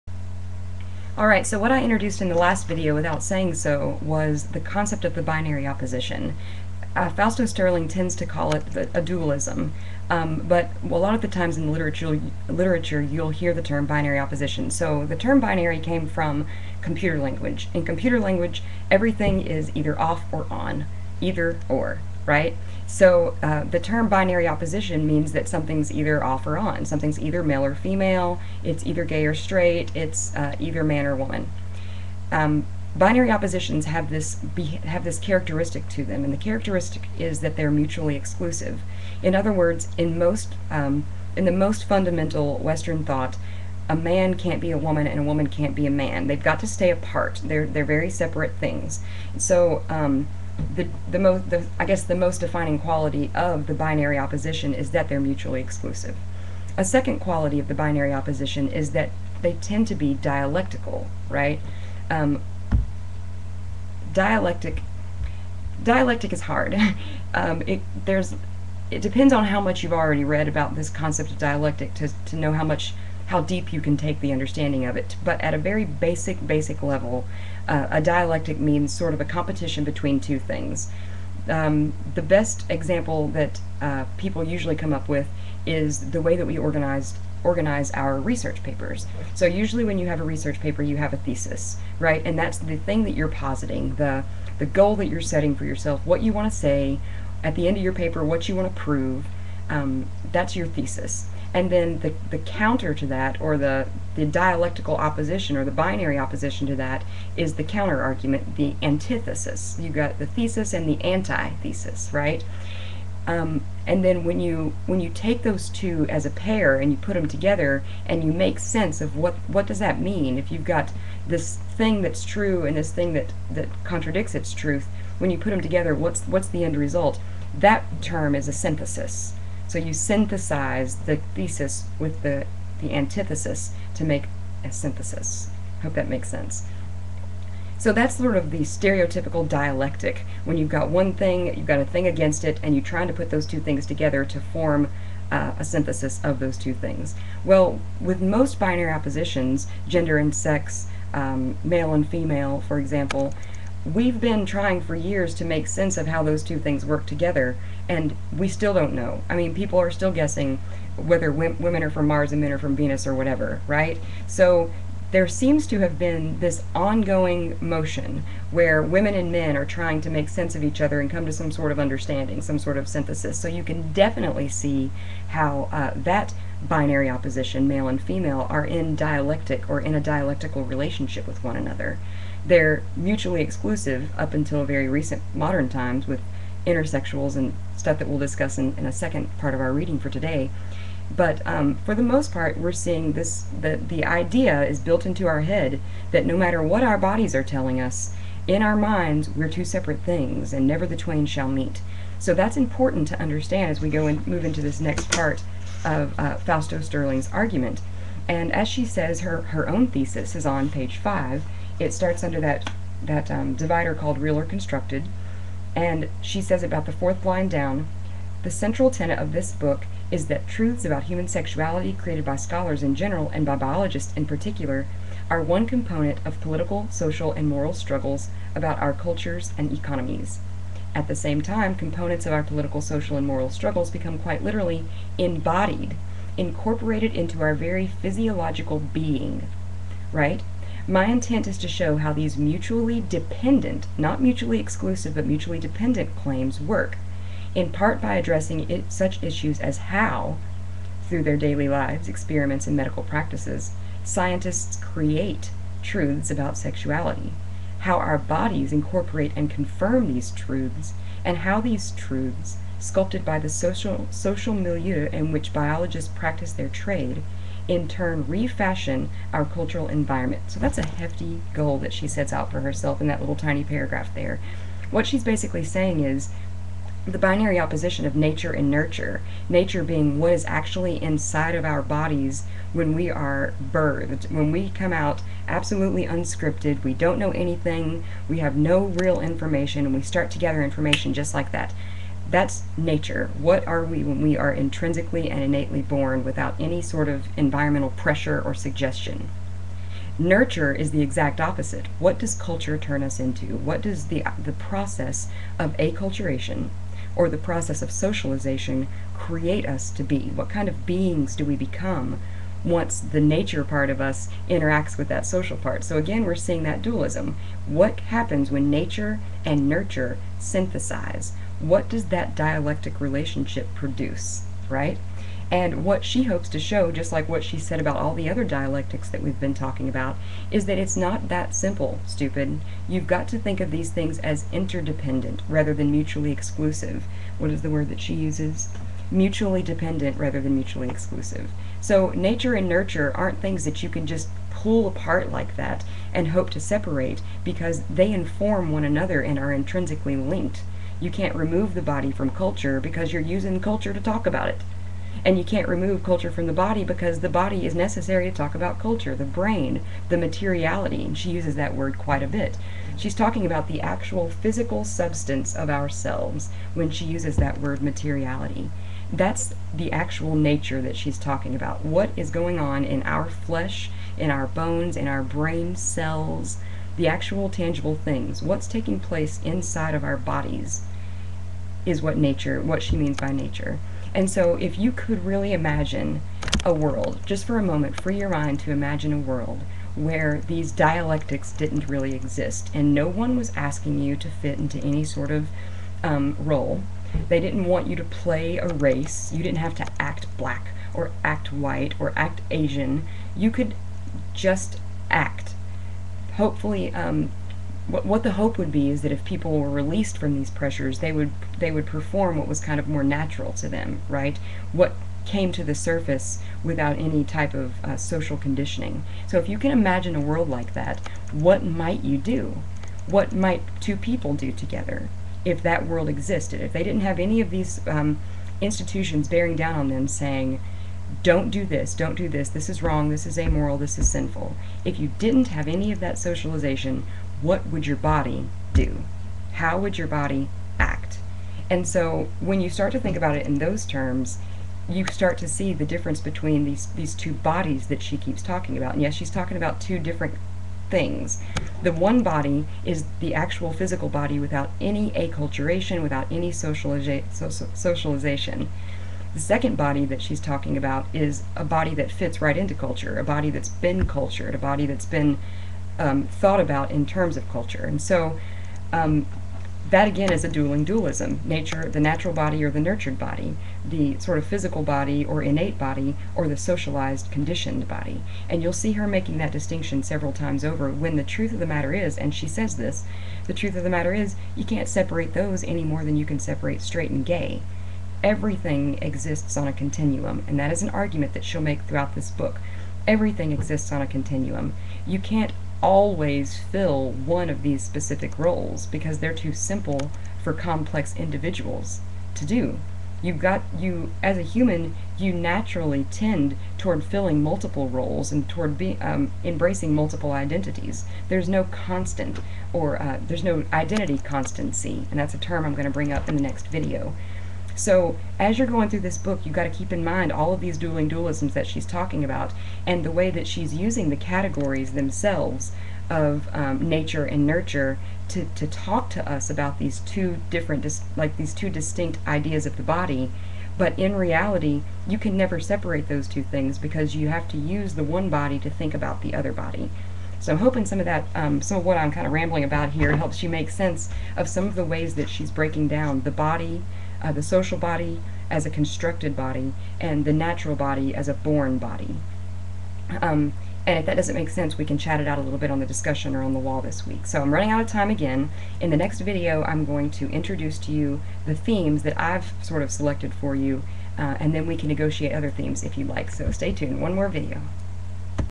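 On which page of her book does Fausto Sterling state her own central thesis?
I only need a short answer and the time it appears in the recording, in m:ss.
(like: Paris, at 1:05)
5, at 3:30.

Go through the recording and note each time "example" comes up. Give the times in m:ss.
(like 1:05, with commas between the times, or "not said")
1:22, 2:32.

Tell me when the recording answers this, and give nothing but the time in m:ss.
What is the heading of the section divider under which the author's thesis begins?
3:34.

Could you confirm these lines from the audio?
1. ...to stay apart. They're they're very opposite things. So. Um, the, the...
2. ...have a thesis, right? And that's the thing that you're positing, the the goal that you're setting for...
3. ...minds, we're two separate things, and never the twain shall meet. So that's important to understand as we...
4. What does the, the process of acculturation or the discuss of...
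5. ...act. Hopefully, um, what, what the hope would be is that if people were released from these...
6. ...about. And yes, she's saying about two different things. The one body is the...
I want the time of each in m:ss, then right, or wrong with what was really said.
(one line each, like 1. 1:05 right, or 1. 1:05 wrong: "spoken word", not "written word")
1. 0:46 wrong: "separate", not "opposite"
2. 1:30 right
3. 3:18 right
4. 5:03 wrong: "process", not "discuss"
5. 6:45 right
6. 7:28 wrong: "talking", not "saying".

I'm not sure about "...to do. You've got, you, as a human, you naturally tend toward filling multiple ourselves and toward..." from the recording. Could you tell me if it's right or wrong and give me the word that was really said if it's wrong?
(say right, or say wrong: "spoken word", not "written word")
wrong: "roles", not "ourselves".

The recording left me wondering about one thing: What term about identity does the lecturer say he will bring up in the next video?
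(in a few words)
identity constancy.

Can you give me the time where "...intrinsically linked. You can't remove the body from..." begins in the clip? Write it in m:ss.
5:49.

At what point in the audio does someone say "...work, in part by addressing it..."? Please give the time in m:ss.
4:06.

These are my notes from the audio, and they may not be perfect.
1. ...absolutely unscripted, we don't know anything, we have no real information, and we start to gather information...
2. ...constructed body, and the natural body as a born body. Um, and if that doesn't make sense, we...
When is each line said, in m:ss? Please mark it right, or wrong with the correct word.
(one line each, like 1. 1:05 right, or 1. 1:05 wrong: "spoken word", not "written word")
1. 4:45 right
2. 9:08 right.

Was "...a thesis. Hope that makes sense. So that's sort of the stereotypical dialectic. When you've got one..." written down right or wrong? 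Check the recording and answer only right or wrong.
wrong.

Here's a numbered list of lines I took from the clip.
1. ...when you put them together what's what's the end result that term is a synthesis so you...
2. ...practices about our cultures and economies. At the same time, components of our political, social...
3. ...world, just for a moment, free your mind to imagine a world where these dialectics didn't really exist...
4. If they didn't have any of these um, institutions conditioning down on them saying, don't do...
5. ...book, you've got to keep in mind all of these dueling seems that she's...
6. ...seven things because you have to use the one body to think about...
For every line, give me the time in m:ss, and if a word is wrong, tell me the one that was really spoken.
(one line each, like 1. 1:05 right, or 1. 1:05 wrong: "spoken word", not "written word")
1. 2:05 right
2. 3:47 wrong: "struggles", not "practices"
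3. 6:26 right
4. 7:06 wrong: "bearing", not "conditioning"
5. 8:39 wrong: "dualisms", not "seems"
6. 8:56 wrong: "two", not "seven".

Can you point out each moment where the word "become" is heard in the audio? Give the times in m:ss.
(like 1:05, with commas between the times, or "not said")
3:53, 5:11.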